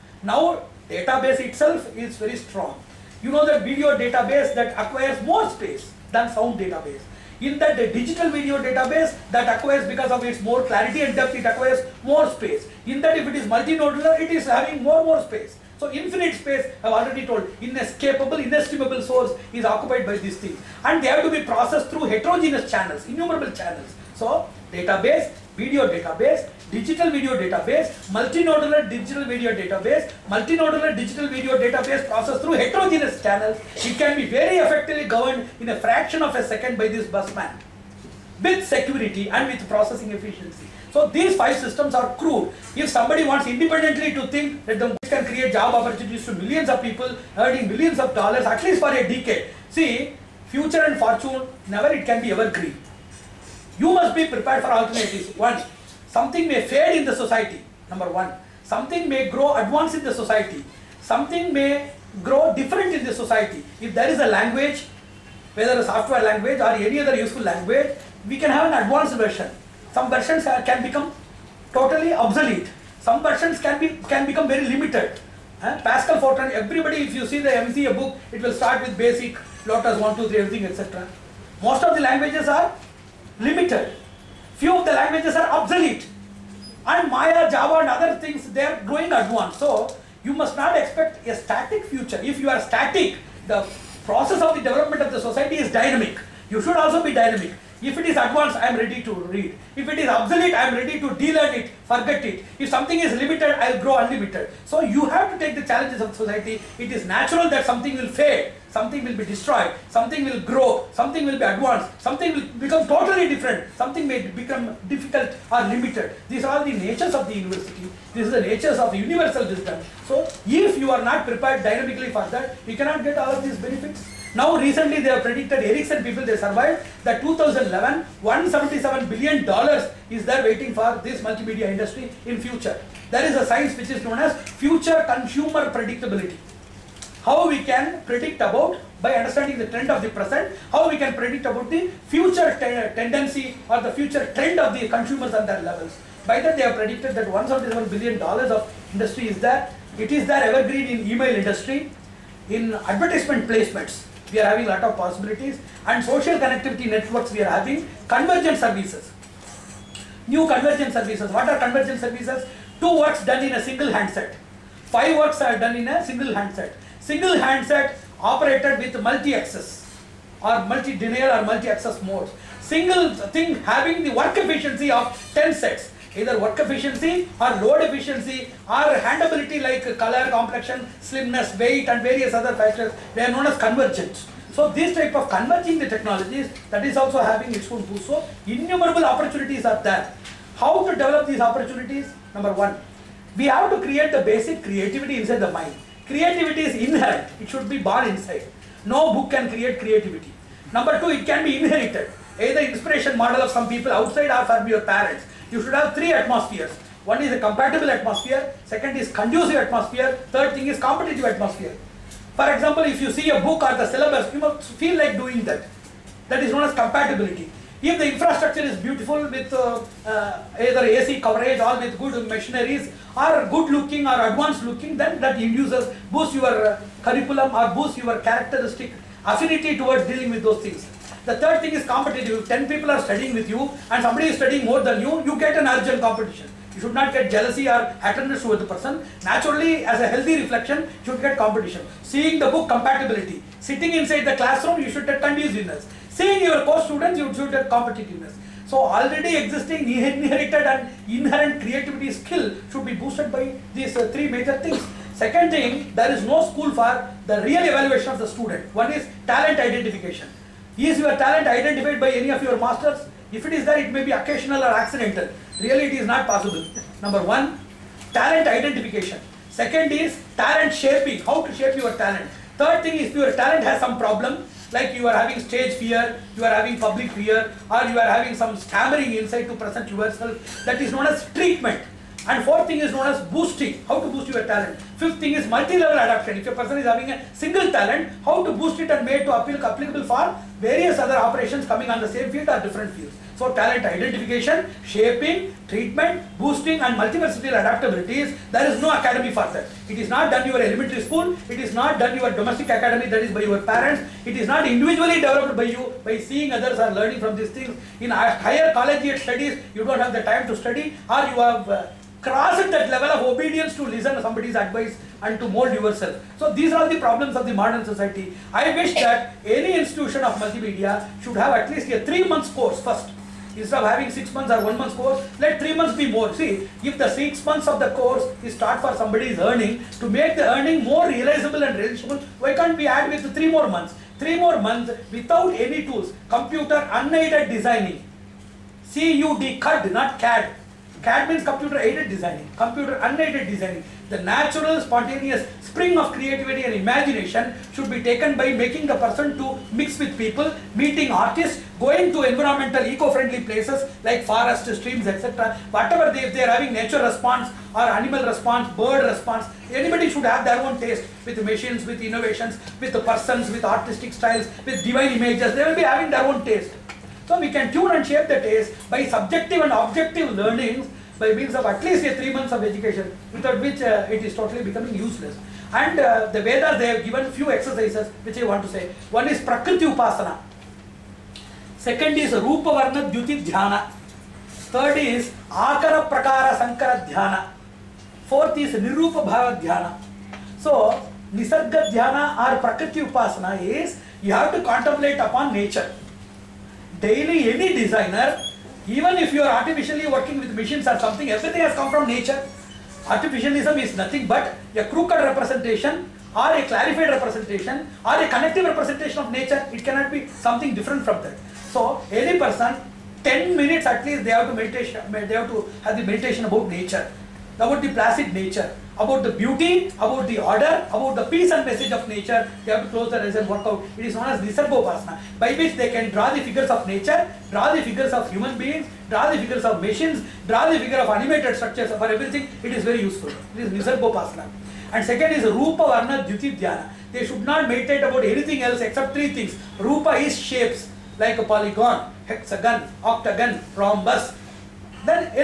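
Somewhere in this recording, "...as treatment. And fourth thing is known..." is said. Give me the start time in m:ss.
4:41.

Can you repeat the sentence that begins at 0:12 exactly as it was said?
In that if it is multinodular, it is having more more space.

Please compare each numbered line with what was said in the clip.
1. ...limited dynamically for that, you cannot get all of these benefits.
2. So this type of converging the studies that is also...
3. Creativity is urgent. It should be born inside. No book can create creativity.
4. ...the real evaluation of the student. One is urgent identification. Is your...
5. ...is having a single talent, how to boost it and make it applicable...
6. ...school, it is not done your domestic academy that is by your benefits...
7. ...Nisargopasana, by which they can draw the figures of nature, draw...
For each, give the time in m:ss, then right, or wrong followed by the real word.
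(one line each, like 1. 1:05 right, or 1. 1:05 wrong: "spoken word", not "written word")
1. 2:01 wrong: "prepared", not "limited"
2. 3:04 wrong: "technologies", not "studies"
3. 3:16 wrong: "inherent", not "urgent"
4. 4:17 wrong: "talent", not "urgent"
5. 4:46 right
6. 5:01 wrong: "parents", not "benefits"
7. 7:04 right.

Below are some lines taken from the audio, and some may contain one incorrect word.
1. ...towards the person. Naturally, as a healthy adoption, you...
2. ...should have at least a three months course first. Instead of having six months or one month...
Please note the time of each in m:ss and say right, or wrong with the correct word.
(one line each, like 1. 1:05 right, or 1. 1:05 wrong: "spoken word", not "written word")
1. 3:58 wrong: "reflection", not "adoption"
2. 5:21 right.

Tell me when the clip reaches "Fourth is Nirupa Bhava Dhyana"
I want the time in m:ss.
6:28.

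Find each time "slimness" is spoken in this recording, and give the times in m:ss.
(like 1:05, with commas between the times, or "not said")
3:01.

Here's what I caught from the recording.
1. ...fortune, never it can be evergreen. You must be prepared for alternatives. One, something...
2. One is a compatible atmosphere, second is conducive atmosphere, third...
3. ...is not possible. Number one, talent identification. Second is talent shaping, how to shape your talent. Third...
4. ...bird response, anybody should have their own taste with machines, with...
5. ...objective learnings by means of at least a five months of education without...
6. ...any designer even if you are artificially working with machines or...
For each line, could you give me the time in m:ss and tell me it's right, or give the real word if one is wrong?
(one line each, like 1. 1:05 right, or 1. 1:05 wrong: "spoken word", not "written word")
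1. 0:50 right
2. 3:27 right
3. 4:25 right
4. 5:58 right
5. 6:09 wrong: "three", not "five"
6. 6:37 right.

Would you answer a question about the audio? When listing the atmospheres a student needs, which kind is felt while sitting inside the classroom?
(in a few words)
conduciveness.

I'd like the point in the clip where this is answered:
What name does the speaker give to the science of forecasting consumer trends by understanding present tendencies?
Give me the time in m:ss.
2:14.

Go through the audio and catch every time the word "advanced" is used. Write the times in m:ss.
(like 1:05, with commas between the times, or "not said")
0:59, 1:08, 1:29, 1:38, 1:51, 3:44.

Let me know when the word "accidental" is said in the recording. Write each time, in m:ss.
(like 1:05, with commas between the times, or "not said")
4:24.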